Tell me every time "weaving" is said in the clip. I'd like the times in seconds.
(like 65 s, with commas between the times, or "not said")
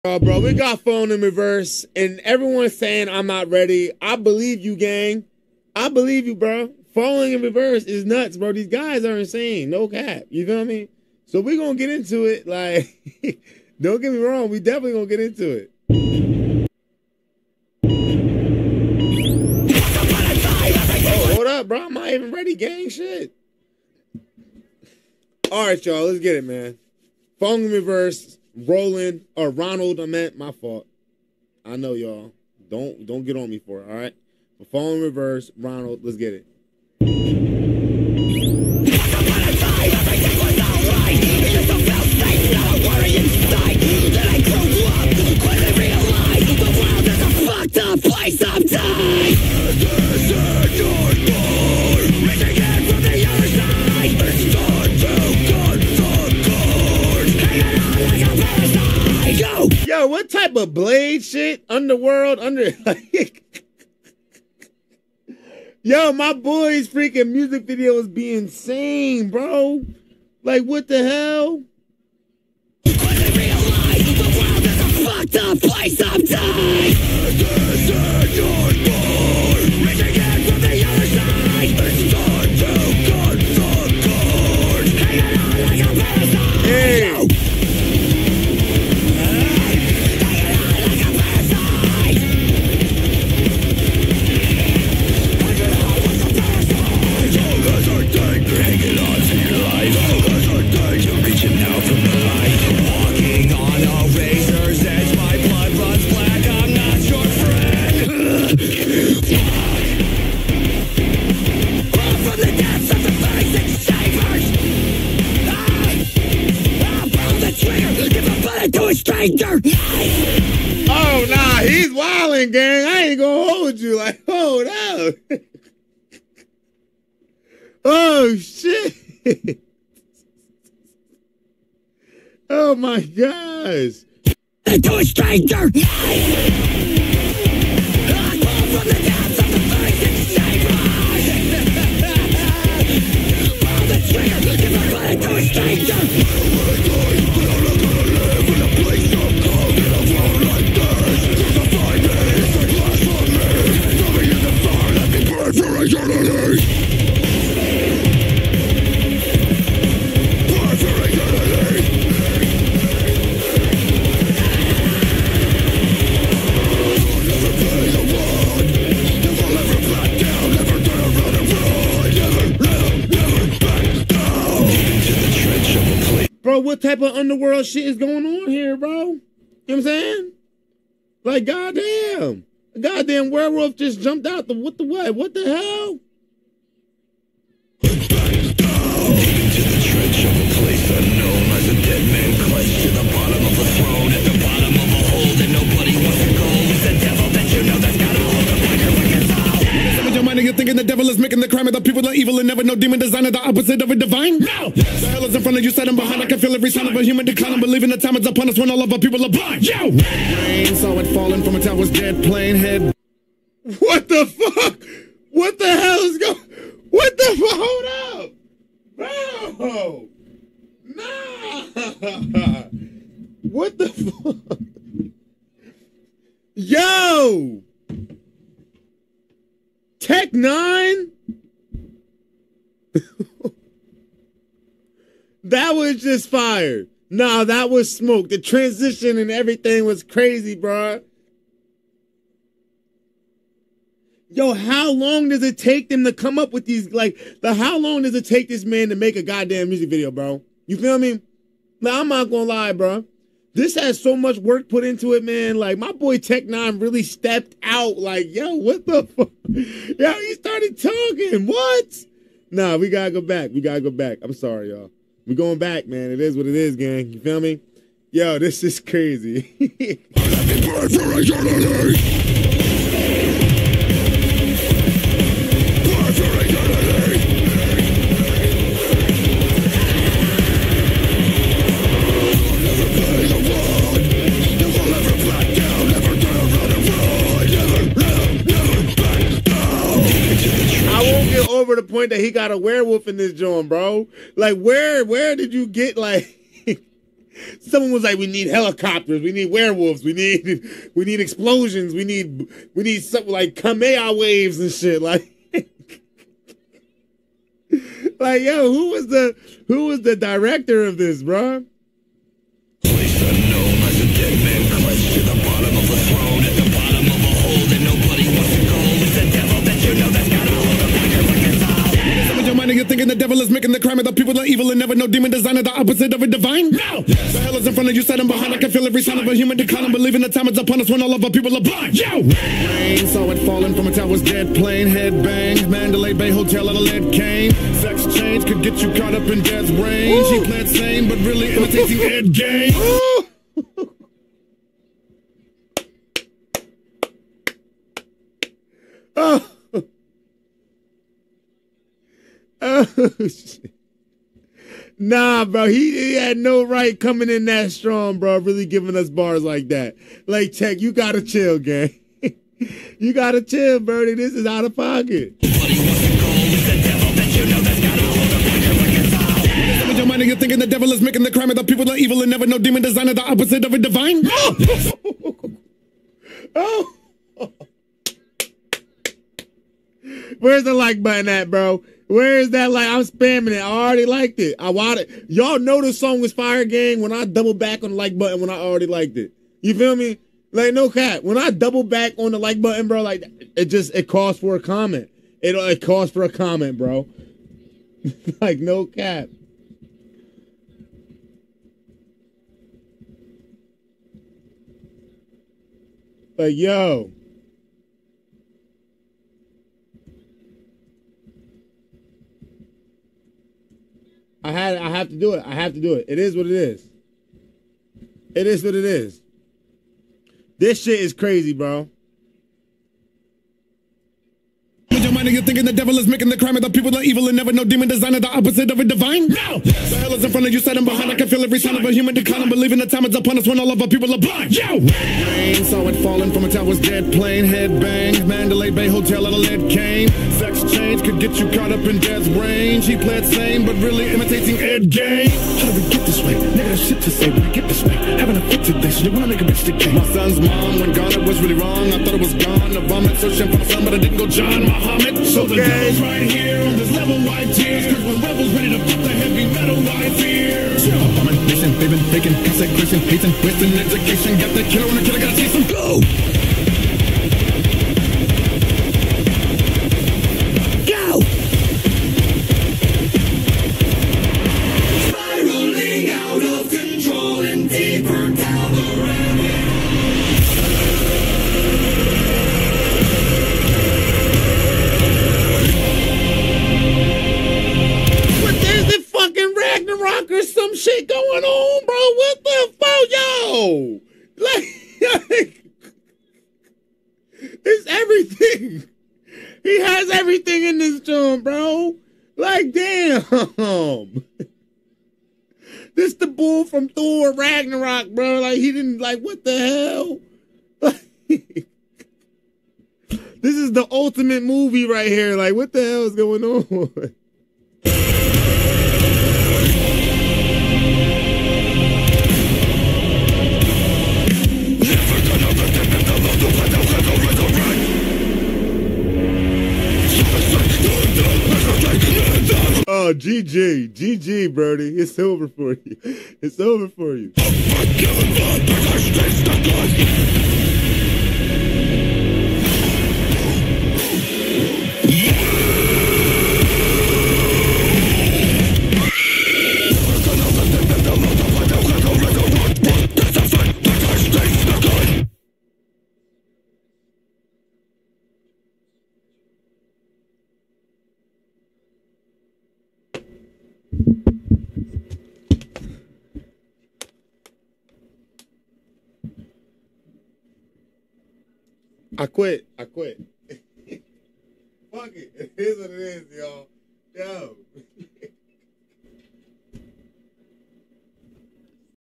not said.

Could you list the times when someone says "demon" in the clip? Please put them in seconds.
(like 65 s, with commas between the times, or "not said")
202 s, 325 s, 372 s, 427 s.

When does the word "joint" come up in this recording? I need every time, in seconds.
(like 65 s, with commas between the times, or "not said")
293 s, 501 s.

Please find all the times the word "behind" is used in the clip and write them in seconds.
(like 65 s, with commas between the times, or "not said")
205 s, 328 s, 430 s.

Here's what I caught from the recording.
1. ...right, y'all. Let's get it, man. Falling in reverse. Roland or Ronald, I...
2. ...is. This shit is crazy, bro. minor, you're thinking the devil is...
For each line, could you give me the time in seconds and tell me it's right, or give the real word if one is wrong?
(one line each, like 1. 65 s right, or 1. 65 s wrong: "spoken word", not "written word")
1. 25 s right
2. 418 s right.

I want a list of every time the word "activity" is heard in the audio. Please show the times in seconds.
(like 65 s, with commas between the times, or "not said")
not said.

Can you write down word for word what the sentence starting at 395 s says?
It it calls for a comment, bro.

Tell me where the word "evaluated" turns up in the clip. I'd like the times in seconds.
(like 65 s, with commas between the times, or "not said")
not said.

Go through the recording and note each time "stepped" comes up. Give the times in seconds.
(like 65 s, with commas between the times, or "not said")
257 s.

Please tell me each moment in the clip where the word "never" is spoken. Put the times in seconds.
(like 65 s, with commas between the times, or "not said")
202 s, 324 s, 372 s, 427 s.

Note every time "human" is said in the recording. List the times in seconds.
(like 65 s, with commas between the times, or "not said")
207 s, 329 s, 431 s.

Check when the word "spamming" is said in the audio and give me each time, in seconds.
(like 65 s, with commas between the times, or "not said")
383 s.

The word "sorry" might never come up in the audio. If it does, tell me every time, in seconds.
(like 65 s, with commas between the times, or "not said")
264 s.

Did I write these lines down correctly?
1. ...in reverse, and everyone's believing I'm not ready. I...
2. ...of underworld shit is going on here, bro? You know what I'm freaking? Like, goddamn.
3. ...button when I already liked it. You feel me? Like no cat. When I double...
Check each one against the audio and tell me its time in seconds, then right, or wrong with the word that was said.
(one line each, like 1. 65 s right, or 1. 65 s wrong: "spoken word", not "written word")
1. 1 s wrong: "saying", not "believing"
2. 177 s wrong: "saying", not "freaking"
3. 388 s right.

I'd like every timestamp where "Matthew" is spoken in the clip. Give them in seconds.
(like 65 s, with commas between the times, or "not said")
not said.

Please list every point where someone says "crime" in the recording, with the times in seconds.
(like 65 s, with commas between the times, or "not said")
201 s, 323 s, 371 s, 426 s.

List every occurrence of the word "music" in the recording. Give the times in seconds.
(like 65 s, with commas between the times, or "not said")
67 s, 249 s.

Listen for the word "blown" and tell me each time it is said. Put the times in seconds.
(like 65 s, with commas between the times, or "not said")
not said.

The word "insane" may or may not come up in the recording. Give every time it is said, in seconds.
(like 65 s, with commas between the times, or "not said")
9 s, 68 s.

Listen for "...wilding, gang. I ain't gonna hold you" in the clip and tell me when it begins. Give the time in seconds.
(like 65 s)
121 s.